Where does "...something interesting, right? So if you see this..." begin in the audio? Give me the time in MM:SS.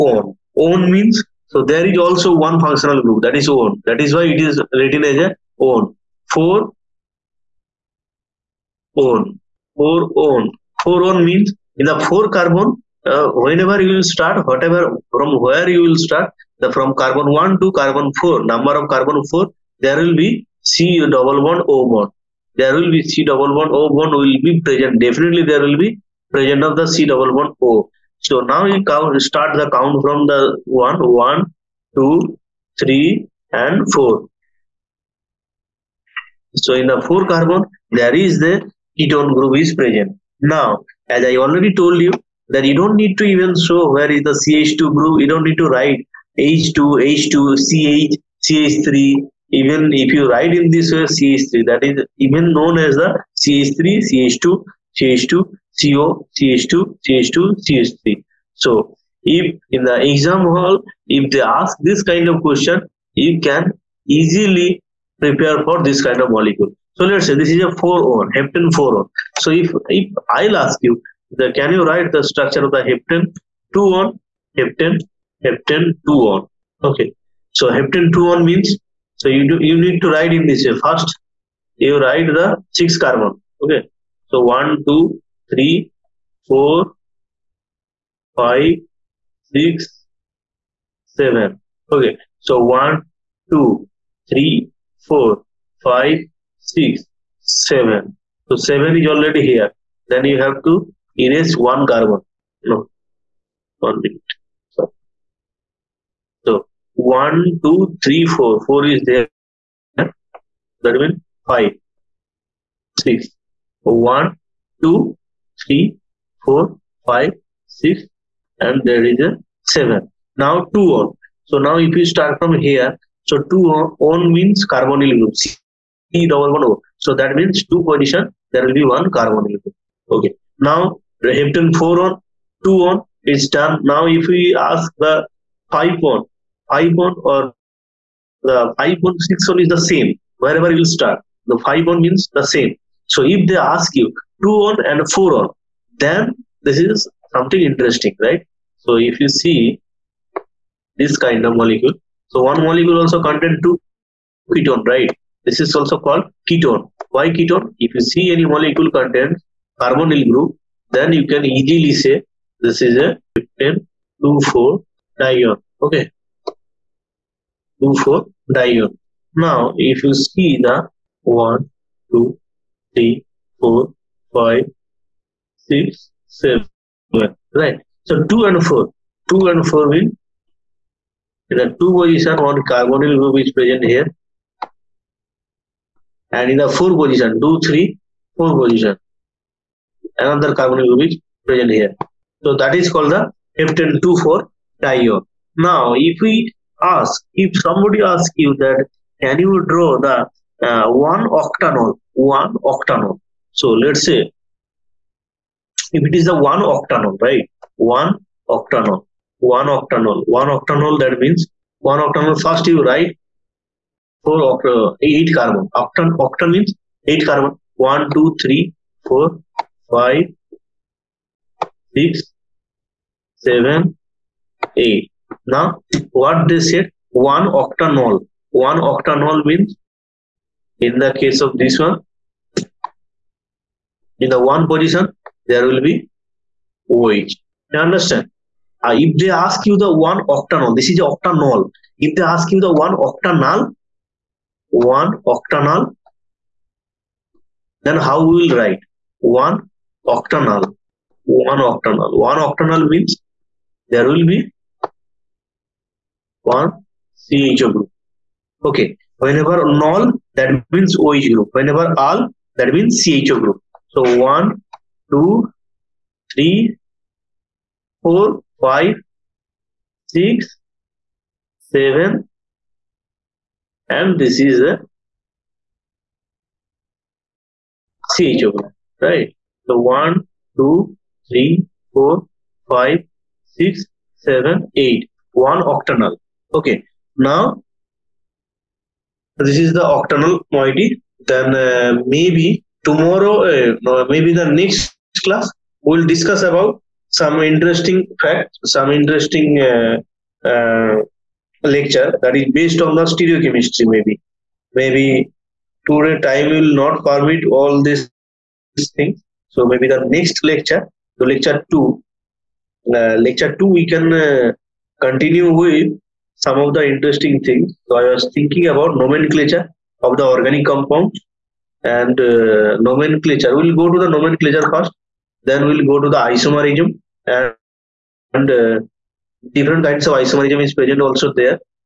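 02:27.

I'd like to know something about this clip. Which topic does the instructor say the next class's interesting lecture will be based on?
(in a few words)
stereochemistry.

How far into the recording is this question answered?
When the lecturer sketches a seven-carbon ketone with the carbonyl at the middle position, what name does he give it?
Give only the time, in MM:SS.
01:08.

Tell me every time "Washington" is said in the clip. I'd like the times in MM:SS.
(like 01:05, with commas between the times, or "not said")
not said.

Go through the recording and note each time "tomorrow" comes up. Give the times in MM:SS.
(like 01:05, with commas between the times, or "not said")
04:52.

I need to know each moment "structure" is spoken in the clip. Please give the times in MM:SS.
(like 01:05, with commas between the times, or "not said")
01:12.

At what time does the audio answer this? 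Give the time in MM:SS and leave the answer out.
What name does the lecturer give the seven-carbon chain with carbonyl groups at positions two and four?
03:13.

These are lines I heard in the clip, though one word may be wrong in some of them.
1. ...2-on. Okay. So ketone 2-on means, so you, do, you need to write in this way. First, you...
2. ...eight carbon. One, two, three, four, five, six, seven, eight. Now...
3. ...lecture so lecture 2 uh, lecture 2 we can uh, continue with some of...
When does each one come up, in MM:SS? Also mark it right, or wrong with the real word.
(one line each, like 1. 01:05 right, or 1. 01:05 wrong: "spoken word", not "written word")
1. 01:16 wrong: "heptane", not "ketone"
2. 03:37 right
3. 05:10 right.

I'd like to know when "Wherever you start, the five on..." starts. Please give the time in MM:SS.
02:20.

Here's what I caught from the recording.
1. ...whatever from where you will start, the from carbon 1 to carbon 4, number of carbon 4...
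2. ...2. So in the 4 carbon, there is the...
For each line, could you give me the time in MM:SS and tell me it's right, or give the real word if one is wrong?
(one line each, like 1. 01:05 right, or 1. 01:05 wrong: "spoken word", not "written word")
1. 00:14 right
2. 00:33 wrong: "4", not "2".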